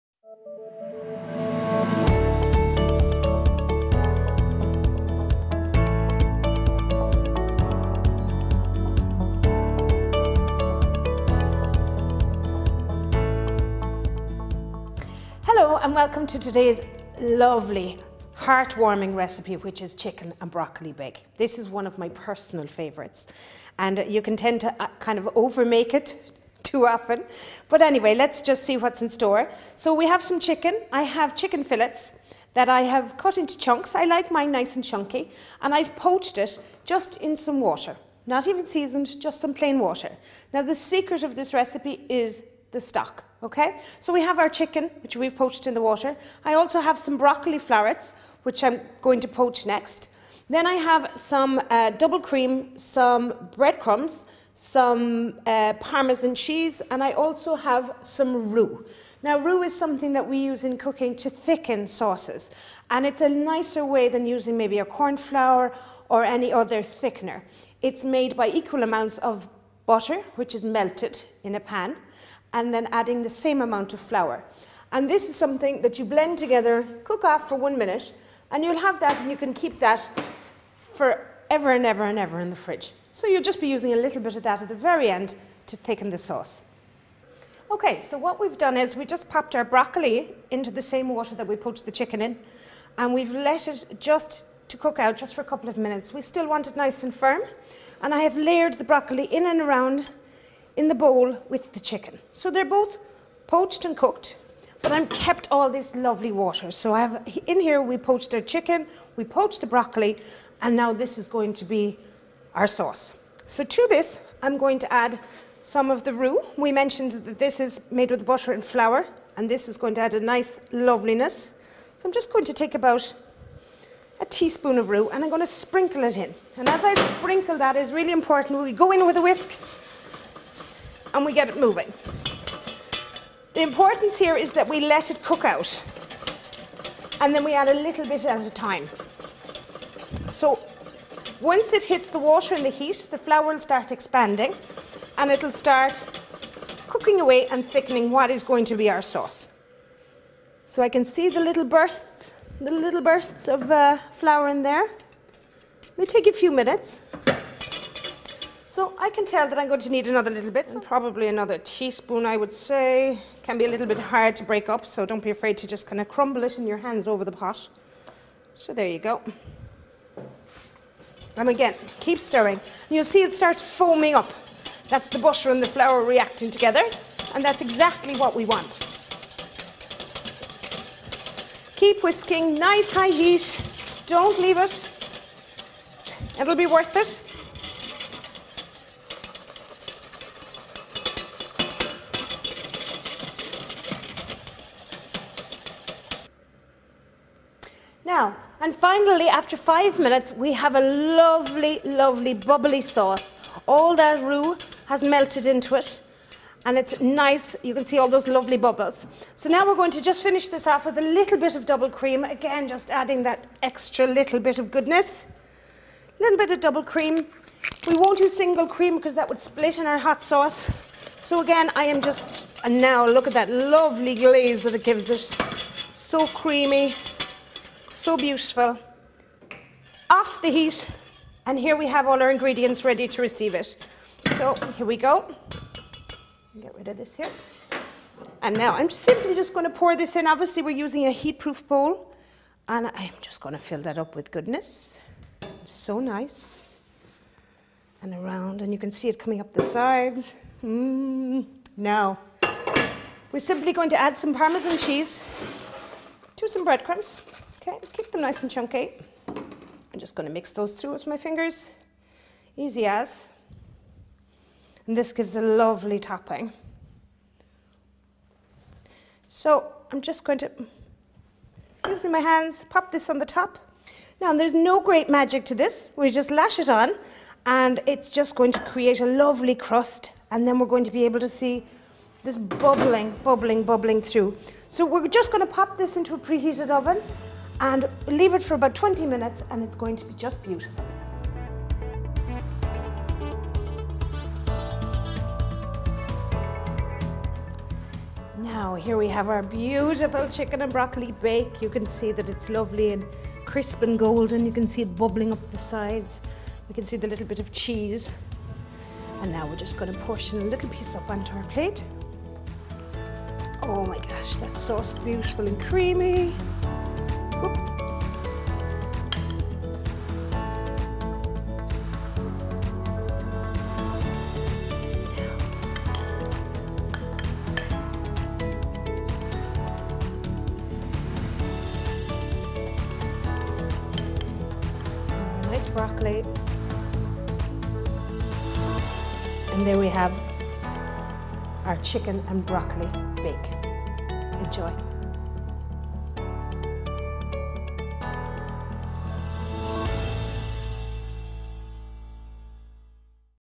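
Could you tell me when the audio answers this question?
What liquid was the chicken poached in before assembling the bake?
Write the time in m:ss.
0:39.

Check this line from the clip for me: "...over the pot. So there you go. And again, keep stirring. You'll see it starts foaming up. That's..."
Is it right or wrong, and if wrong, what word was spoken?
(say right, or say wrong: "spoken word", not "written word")
right.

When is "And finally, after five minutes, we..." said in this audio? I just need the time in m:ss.
3:18.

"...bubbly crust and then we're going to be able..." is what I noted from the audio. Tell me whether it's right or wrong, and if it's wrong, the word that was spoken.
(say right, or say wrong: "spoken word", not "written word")
wrong: "lovely", not "bubbly".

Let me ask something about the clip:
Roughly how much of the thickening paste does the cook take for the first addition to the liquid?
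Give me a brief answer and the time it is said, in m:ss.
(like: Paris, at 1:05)
a teaspoon, at 2:02.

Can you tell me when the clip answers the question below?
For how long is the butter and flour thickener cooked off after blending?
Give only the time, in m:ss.
1:17.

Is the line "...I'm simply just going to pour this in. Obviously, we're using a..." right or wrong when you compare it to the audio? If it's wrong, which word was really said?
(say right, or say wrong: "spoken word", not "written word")
right.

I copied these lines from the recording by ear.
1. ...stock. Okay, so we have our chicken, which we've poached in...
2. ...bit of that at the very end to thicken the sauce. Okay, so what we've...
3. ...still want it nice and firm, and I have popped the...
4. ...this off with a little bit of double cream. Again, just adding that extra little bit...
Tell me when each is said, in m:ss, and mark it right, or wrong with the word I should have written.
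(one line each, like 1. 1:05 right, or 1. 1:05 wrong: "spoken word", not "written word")
1. 0:42 right
2. 1:24 right
3. 1:36 wrong: "layered", not "popped"
4. 3:30 right.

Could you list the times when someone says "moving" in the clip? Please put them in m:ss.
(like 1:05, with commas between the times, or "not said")
2:11.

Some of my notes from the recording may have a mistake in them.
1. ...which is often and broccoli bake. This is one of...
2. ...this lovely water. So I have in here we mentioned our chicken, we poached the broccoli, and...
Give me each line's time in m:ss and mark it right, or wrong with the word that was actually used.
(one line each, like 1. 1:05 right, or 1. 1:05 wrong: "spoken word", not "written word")
1. 0:19 wrong: "chicken", not "often"
2. 1:45 wrong: "poached", not "mentioned".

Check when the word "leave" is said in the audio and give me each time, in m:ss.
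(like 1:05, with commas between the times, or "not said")
3:04, 4:48.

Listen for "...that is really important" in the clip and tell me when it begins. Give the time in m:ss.
2:07.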